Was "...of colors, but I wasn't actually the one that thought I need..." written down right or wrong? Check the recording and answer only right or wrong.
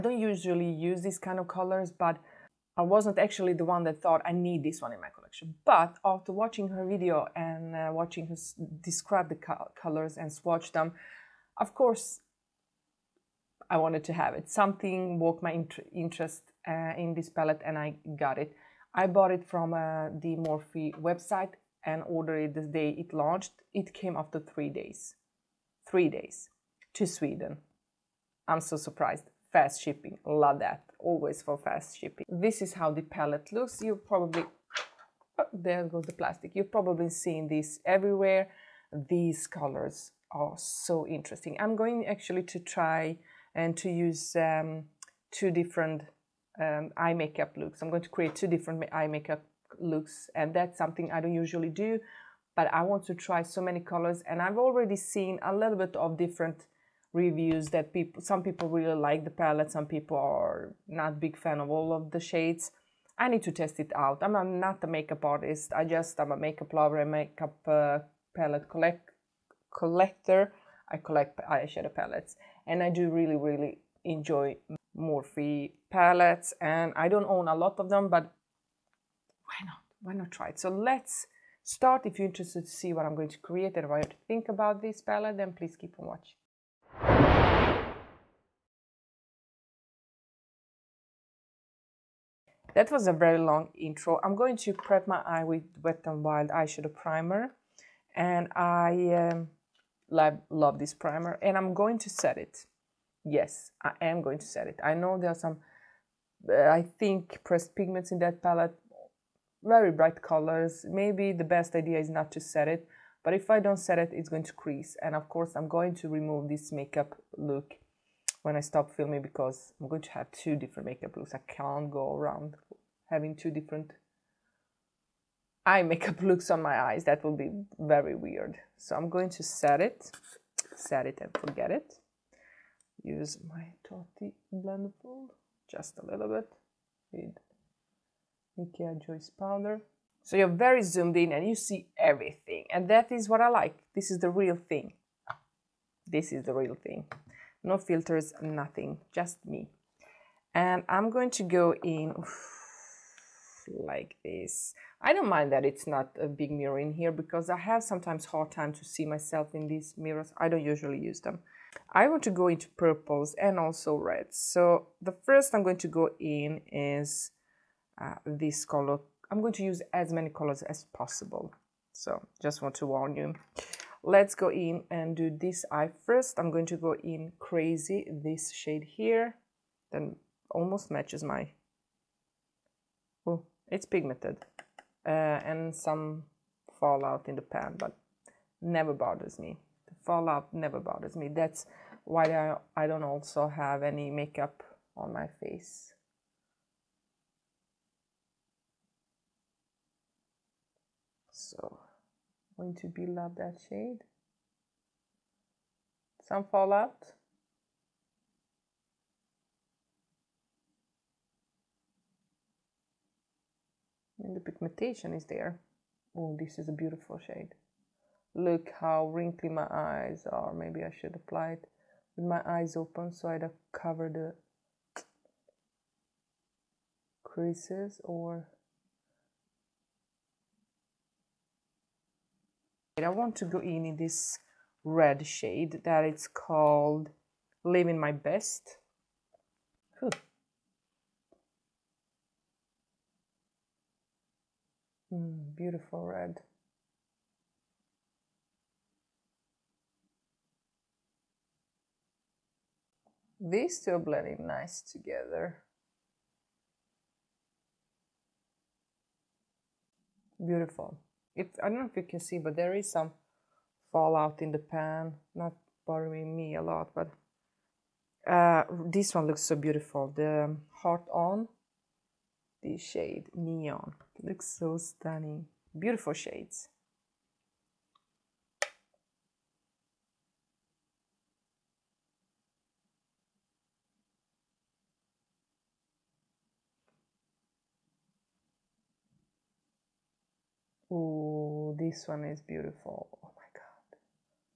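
right.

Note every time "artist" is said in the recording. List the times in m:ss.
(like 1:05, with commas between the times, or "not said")
1:05.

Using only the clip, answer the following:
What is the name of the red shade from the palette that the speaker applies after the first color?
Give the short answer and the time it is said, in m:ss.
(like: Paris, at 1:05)
Living My Best, at 3:57.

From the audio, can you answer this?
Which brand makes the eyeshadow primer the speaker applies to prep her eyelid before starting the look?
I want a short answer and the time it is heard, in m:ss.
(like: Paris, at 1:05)
Wet n Wild, at 1:35.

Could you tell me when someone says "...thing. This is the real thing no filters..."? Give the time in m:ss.
2:24.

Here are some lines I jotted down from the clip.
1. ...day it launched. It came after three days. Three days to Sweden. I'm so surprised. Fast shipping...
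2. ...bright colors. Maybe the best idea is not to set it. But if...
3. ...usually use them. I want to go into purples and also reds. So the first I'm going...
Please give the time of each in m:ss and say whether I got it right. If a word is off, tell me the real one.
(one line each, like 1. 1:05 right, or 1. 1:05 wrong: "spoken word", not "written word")
1. 0:22 right
2. 1:49 right
3. 2:40 right.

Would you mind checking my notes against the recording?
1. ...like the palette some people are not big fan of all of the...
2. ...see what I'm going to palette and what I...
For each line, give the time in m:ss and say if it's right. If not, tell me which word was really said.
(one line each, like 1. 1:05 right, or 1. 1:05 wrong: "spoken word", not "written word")
1. 0:58 right
2. 1:22 wrong: "create", not "palette".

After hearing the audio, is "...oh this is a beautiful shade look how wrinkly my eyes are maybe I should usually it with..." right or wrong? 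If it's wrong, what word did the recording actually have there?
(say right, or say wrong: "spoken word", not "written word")
wrong: "apply", not "usually".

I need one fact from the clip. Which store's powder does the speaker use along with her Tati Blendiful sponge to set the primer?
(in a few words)
Ikea.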